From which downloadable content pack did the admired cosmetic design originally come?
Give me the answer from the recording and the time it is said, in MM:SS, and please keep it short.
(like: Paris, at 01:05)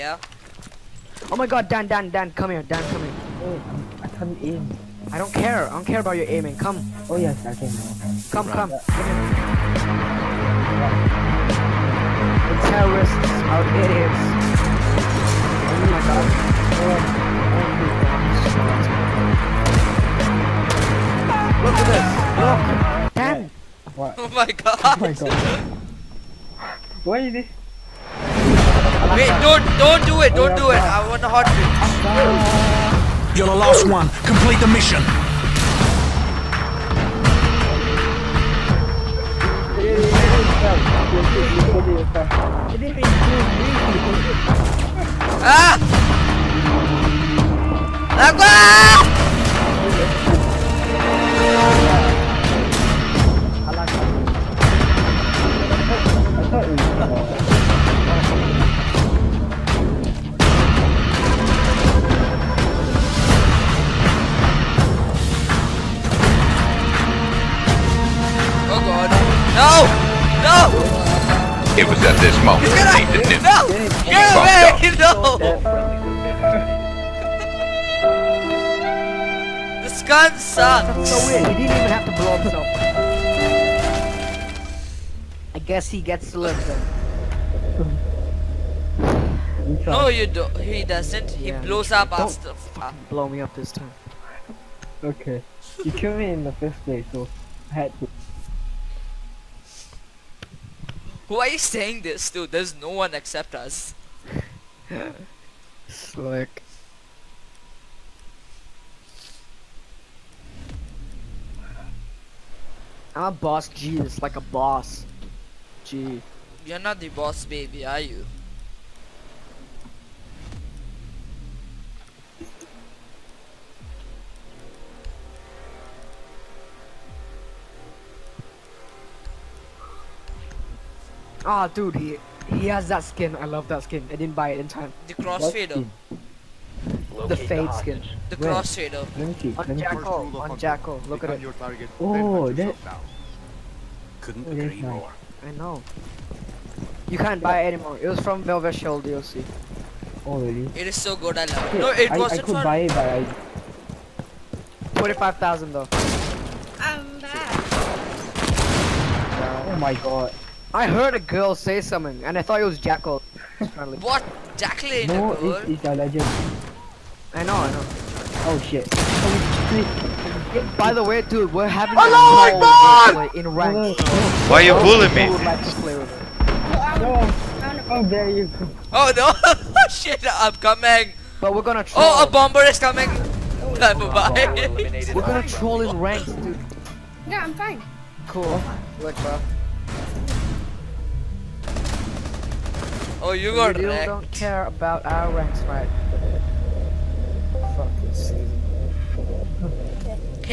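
Velvet Shell, at 02:28.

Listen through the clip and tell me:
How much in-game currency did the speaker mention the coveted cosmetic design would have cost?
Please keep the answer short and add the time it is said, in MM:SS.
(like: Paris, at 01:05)
45,000, at 02:34.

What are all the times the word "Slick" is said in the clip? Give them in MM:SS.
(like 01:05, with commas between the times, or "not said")
01:45.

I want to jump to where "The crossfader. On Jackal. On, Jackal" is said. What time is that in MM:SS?
02:18.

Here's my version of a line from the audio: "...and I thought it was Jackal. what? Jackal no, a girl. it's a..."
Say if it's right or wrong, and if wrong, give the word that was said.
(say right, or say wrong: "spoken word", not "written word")
right.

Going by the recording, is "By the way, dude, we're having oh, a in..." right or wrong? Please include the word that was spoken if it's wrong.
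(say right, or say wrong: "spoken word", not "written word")
right.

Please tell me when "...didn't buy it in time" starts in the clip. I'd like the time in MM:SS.
02:14.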